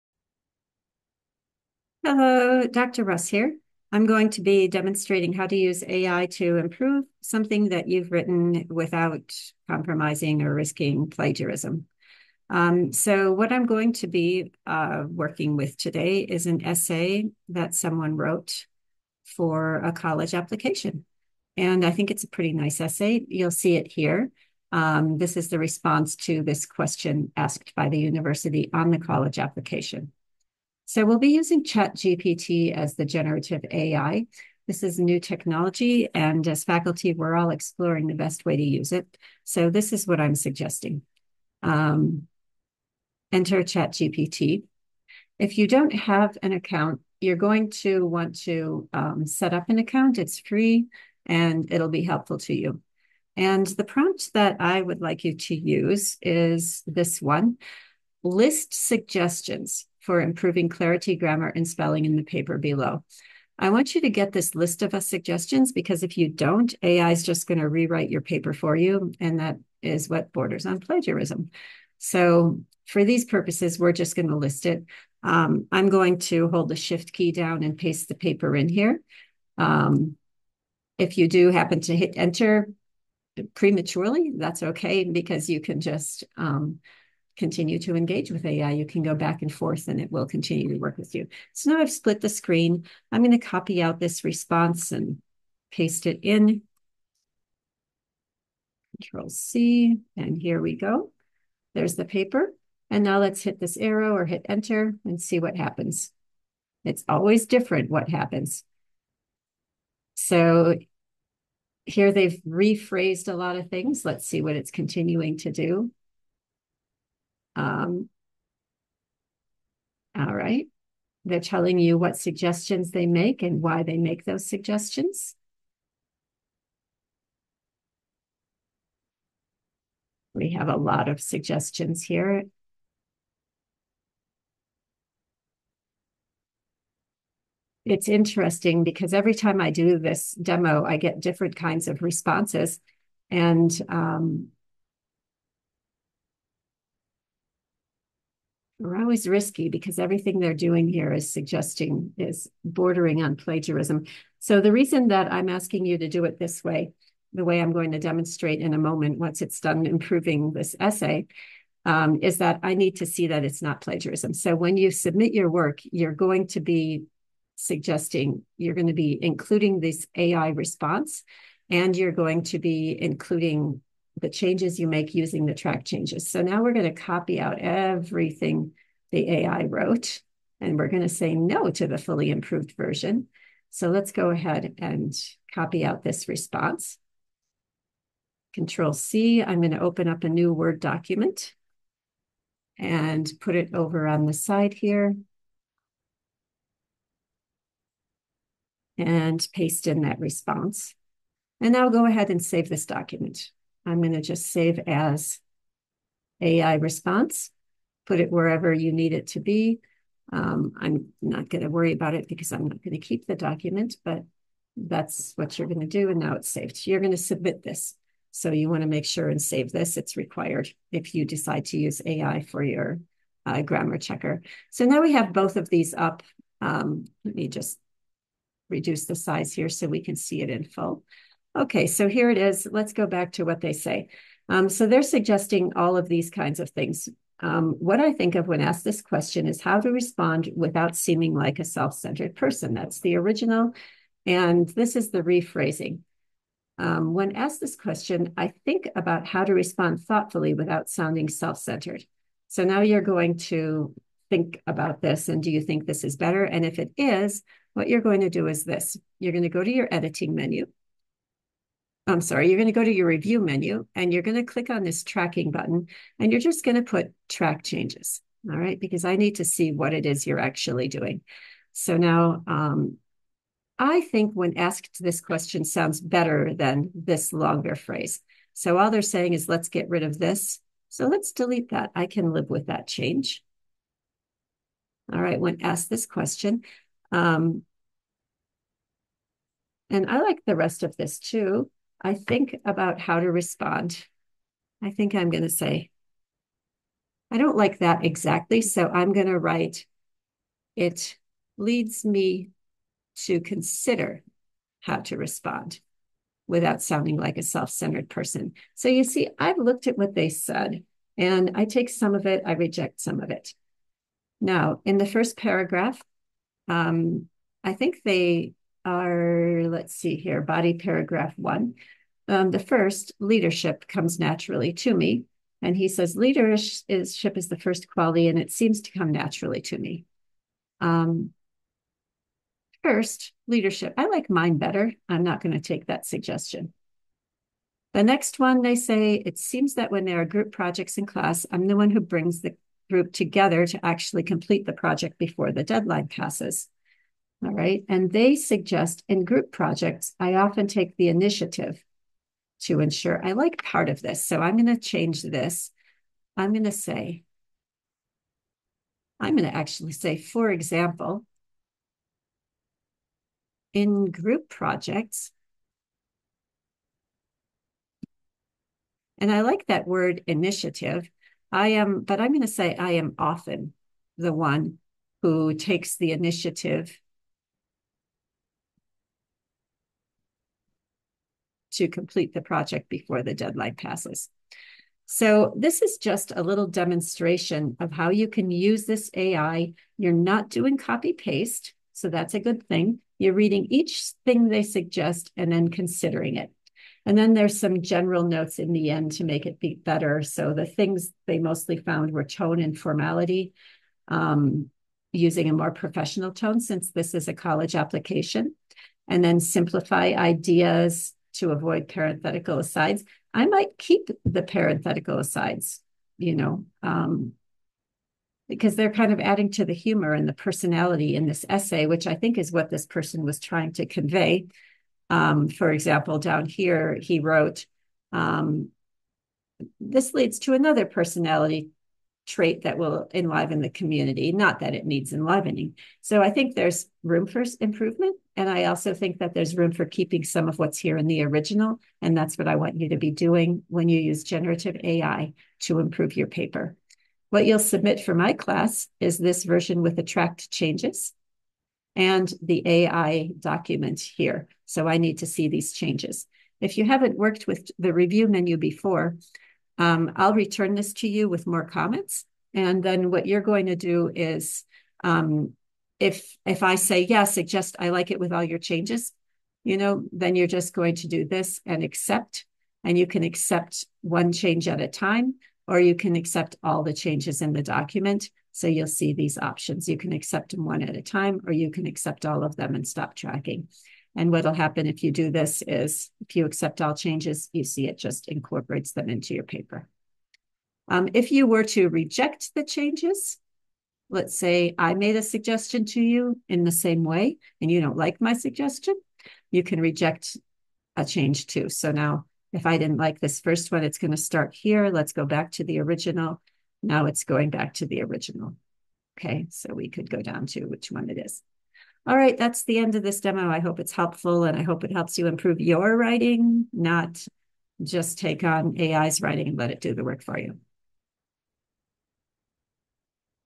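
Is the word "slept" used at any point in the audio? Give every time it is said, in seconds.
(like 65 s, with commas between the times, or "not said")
not said.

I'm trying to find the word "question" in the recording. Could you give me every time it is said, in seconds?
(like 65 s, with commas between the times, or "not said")
26 s, 239 s, 247 s, 275 s, 286 s.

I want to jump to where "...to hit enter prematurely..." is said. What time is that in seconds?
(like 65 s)
81 s.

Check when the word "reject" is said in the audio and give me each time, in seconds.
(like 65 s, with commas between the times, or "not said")
312 s, 491 s, 499 s.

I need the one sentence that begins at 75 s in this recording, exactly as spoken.
Um, I'm going to hold the shift key down and paste the paper in here.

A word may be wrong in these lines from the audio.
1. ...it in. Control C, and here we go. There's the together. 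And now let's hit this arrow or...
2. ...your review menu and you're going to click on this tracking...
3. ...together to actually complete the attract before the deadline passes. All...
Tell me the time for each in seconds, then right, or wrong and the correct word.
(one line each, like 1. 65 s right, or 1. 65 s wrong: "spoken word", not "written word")
1. 96 s wrong: "paper", not "together"
2. 262 s right
3. 343 s wrong: "project", not "attract".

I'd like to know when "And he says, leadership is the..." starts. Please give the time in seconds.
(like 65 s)
325 s.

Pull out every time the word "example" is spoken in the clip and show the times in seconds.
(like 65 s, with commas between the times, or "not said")
360 s, 425 s.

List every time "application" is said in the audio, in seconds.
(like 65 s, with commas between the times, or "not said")
20 s, 29 s, 407 s.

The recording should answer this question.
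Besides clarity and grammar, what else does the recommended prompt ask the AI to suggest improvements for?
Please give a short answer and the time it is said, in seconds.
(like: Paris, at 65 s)
spelling, at 61 s.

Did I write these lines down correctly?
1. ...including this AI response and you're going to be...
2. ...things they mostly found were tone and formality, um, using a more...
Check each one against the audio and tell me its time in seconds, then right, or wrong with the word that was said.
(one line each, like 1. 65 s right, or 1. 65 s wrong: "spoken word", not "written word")
1. 169 s right
2. 400 s right.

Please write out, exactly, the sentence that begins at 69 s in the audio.
And that is what borders on plagiarism.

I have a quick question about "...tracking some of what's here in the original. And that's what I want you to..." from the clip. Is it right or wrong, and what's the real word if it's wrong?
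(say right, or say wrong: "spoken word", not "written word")
wrong: "keeping", not "tracking".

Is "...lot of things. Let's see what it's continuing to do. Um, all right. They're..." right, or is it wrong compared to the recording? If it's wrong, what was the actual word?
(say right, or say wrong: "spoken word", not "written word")
right.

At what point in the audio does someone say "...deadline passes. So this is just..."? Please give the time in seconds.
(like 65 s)
383 s.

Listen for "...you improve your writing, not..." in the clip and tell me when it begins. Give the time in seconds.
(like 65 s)
515 s.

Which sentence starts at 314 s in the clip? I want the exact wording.
Now, in the first paragraph, um, I think they are, let's see here, body paragraph one.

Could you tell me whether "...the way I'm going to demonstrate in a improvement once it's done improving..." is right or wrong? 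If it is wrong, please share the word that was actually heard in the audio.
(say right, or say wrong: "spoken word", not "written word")
wrong: "moment", not "improvement".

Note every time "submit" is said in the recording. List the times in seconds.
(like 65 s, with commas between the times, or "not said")
164 s, 217 s, 447 s.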